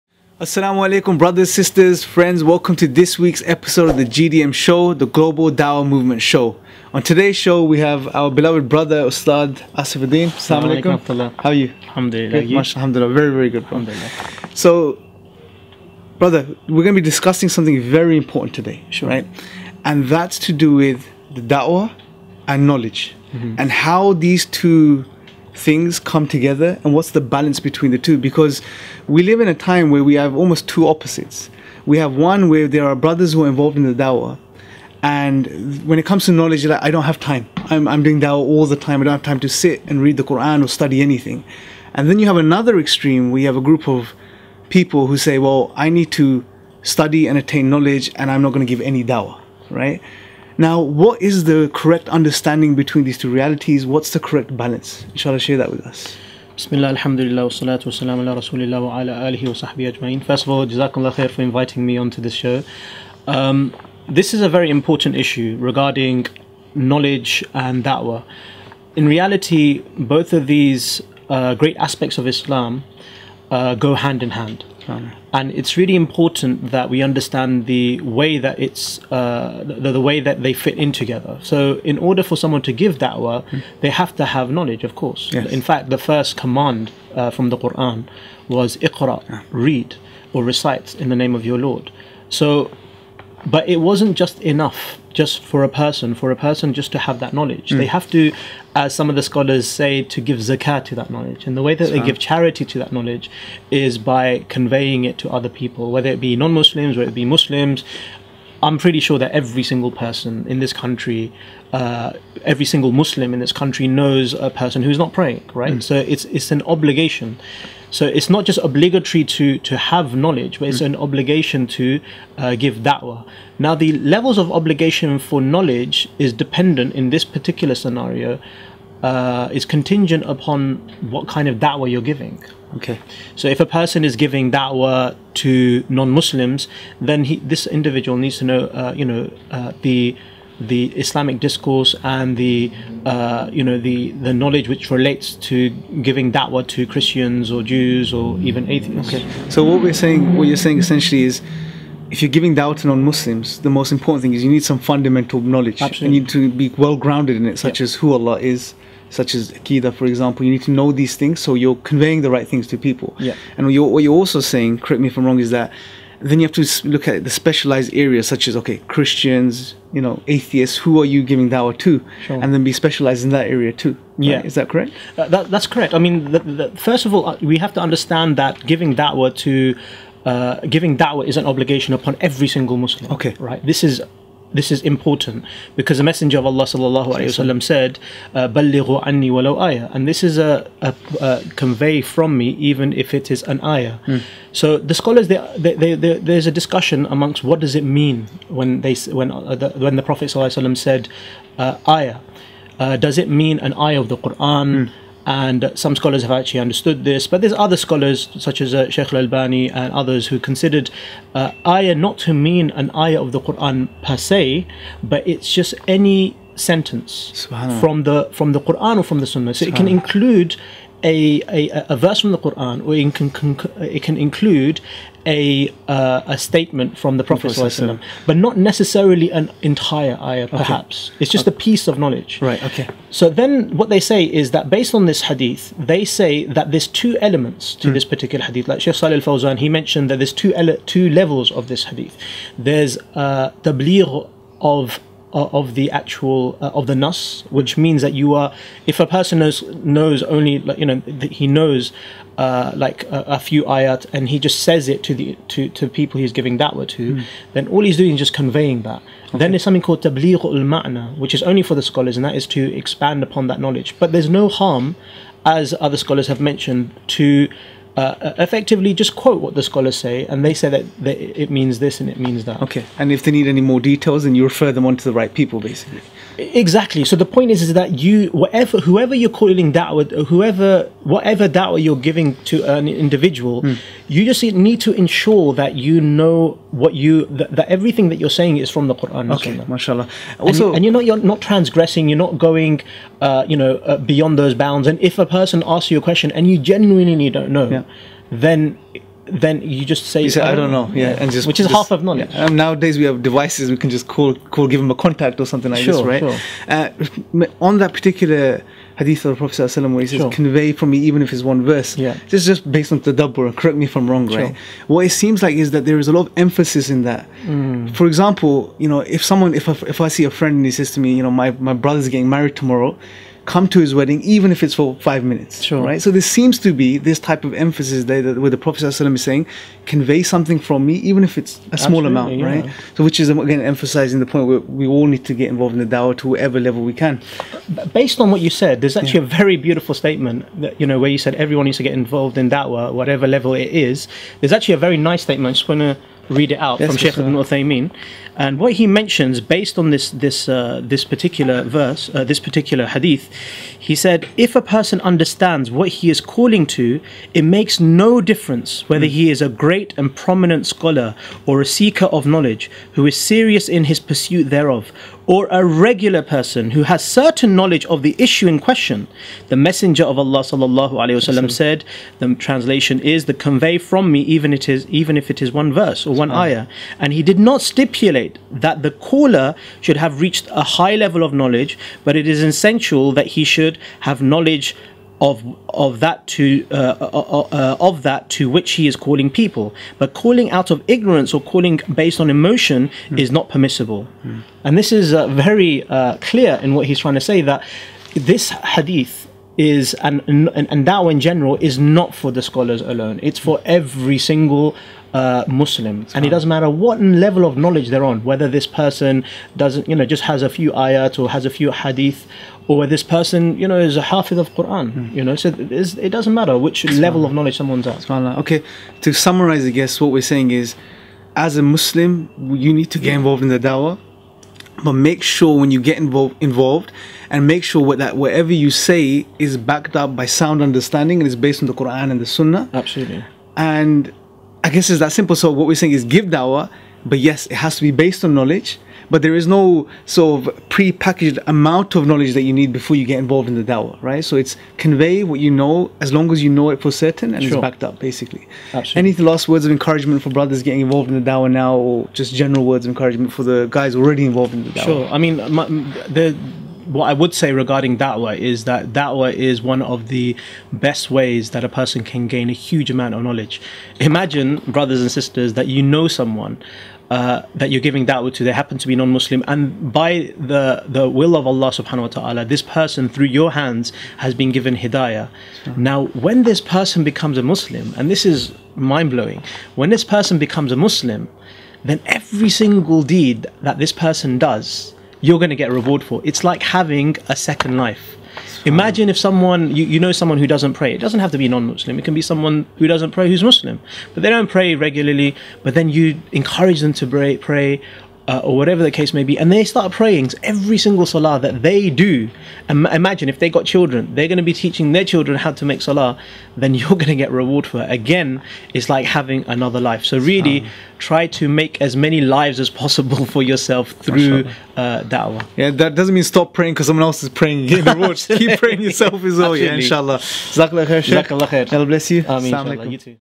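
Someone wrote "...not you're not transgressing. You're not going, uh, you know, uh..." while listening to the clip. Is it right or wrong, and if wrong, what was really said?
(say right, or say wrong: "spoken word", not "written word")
right.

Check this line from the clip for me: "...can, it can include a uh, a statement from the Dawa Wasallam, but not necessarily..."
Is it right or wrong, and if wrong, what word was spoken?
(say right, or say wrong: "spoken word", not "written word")
wrong: "Prophet", not "Dawa".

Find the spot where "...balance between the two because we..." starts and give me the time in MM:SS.
00:27.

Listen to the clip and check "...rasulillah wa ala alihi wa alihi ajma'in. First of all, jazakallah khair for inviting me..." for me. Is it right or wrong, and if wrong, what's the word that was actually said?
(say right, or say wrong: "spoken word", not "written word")
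wrong: "sahbihi", not "alihi".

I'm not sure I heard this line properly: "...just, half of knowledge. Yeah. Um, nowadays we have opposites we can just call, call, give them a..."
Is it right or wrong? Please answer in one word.
wrong.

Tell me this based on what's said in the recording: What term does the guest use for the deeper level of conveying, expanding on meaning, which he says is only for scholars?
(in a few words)
tabligh al ma'na.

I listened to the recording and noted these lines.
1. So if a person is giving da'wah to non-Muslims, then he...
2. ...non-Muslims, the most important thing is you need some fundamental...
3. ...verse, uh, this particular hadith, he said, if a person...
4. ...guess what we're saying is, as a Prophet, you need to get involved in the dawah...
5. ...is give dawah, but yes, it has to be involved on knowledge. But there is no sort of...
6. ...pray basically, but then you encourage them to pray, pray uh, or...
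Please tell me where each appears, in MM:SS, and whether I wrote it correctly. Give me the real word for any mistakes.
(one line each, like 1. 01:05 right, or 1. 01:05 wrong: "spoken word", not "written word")
1. 02:13 right
2. 02:32 right
3. 05:51 right
4. 06:59 wrong: "Muslim", not "Prophet"
5. 07:15 wrong: "based", not "involved"
6. 08:14 wrong: "regularly", not "basically".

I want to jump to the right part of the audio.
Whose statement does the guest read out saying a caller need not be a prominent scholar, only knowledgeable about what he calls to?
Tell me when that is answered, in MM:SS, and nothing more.
05:47.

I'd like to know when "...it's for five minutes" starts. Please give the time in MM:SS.
05:24.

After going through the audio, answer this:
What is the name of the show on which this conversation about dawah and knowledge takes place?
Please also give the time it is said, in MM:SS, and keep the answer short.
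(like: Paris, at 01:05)
Global Dawah Movement show, at 00:04.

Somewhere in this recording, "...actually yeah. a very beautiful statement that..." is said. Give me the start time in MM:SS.
05:38.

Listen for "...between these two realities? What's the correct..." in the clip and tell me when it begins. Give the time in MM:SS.
00:52.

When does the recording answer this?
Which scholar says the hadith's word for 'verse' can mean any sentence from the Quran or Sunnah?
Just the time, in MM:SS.
03:28.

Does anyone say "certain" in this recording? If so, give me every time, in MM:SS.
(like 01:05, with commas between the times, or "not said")
06:07, 07:26.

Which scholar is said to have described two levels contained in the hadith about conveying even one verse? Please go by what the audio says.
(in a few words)
Sheikh Salih al-Fawzan.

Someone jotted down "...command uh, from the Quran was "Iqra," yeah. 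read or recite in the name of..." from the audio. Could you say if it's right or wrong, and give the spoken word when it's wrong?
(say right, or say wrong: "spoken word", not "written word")
right.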